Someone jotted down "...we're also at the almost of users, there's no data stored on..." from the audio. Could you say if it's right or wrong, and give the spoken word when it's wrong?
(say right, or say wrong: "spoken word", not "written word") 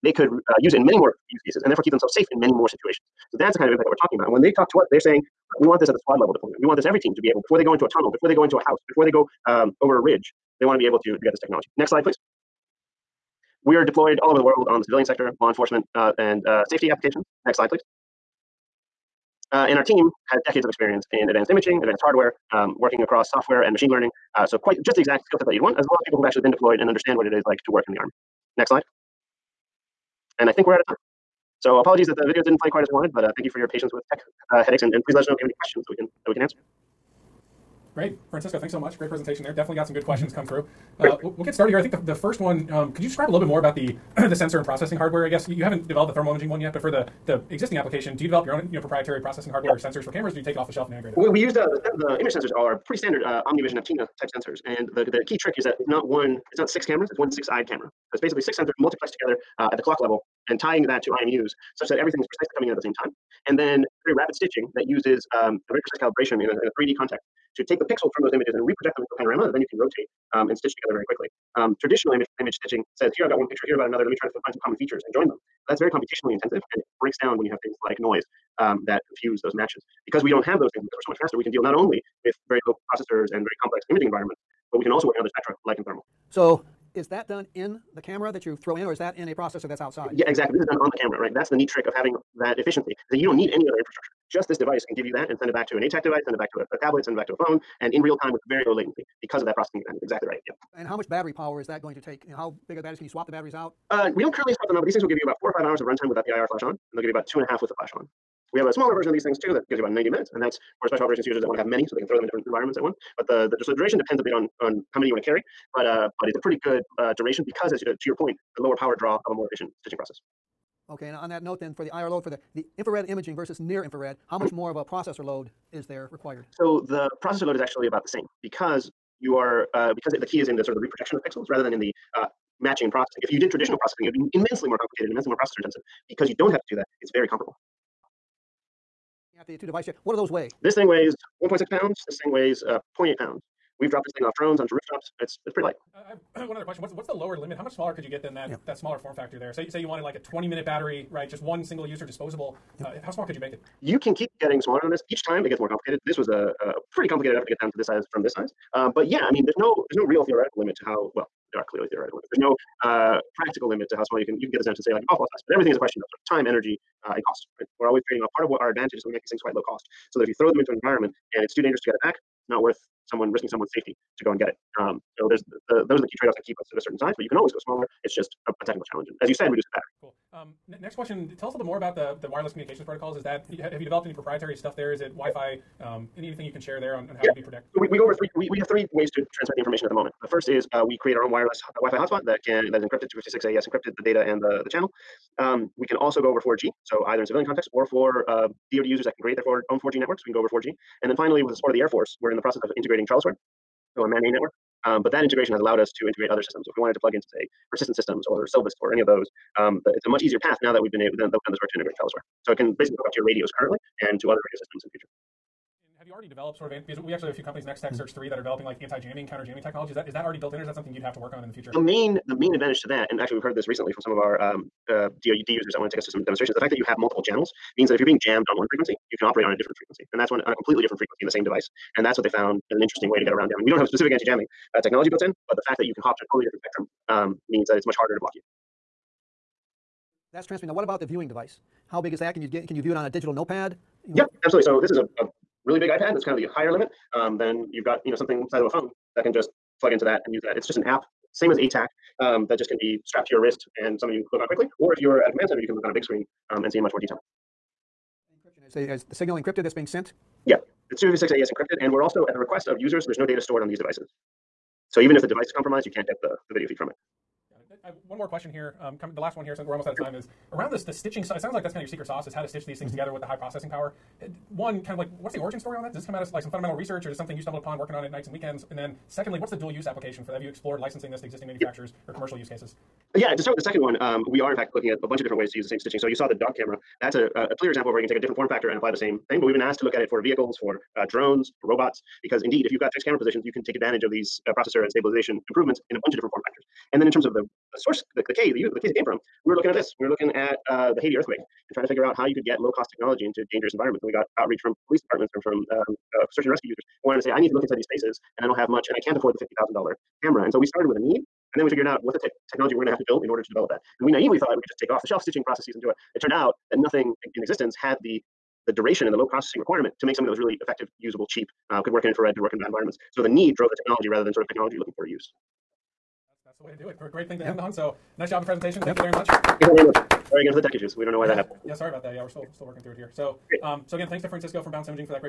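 wrong: "request", not "almost".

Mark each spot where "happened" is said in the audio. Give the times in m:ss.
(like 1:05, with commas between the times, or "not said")
5:31.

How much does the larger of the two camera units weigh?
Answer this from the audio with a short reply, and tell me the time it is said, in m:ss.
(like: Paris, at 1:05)
1.6 pounds, at 2:21.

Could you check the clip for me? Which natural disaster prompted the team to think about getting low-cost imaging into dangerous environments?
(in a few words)
Haiti earthquake.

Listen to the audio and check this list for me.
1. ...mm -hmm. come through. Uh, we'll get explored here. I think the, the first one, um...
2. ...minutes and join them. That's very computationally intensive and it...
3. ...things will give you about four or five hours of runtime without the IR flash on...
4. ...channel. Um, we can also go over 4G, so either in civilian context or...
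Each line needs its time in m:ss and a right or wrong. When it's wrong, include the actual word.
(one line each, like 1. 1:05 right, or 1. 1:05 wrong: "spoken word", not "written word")
1. 0:40 wrong: "started", not "explored"
2. 1:14 wrong: "features", not "minutes"
3. 1:44 right
4. 3:14 right.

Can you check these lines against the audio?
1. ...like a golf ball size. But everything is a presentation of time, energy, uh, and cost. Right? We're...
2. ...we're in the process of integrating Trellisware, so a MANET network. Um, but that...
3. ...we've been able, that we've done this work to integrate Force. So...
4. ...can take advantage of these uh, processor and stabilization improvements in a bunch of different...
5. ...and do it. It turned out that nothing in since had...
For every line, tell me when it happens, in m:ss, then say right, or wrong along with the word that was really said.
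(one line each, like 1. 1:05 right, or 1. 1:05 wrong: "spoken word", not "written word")
1. 2:44 wrong: "question", not "presentation"
2. 3:22 right
3. 3:30 wrong: "Trellisware", not "Force"
4. 4:53 right
5. 5:15 wrong: "existence", not "since".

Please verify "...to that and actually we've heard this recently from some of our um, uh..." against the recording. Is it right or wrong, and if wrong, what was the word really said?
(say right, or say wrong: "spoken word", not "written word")
right.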